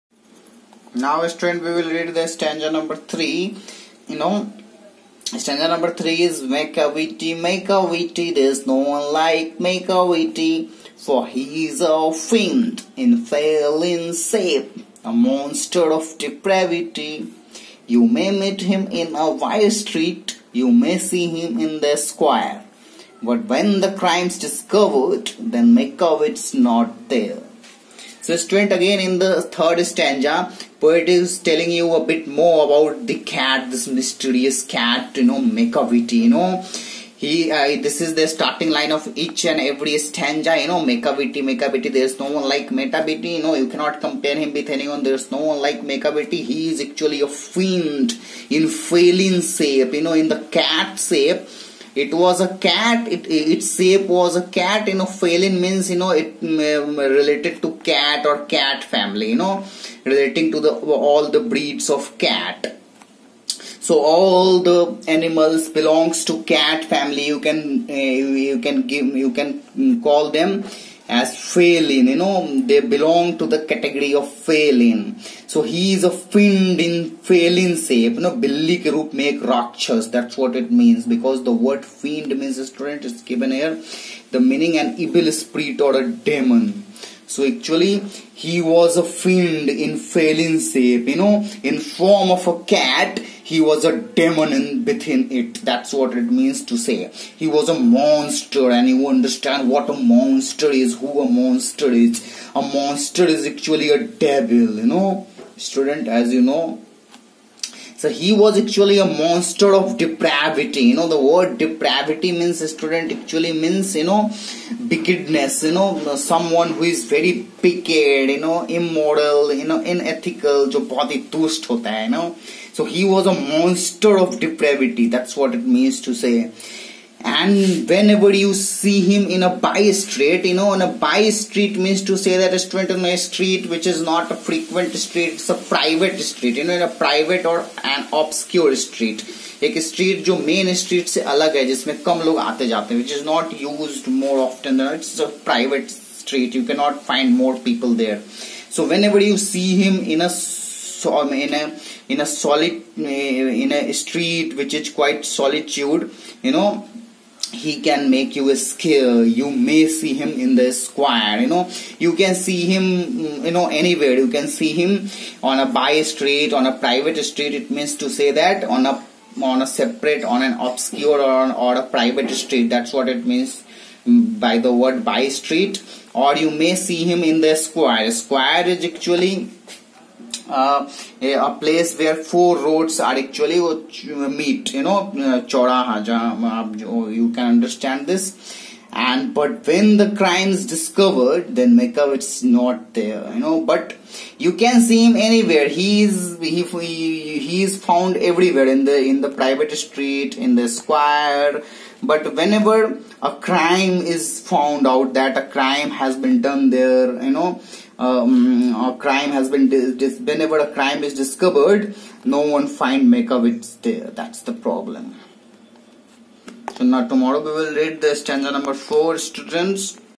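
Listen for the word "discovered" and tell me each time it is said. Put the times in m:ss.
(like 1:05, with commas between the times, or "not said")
0:24, 3:10, 3:31.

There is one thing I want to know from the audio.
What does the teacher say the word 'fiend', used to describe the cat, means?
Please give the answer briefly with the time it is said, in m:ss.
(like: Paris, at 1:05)
an evil spirit or a demon, at 1:24.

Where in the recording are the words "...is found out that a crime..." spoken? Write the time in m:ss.
3:24.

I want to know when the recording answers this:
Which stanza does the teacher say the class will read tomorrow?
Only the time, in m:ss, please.
3:38.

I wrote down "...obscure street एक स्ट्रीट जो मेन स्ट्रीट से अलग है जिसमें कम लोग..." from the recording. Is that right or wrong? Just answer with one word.
right.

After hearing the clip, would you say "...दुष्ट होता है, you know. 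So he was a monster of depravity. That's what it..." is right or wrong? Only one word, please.
right.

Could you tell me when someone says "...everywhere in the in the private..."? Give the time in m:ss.
3:18.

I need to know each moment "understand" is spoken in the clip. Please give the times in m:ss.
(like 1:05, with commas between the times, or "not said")
1:39, 3:07.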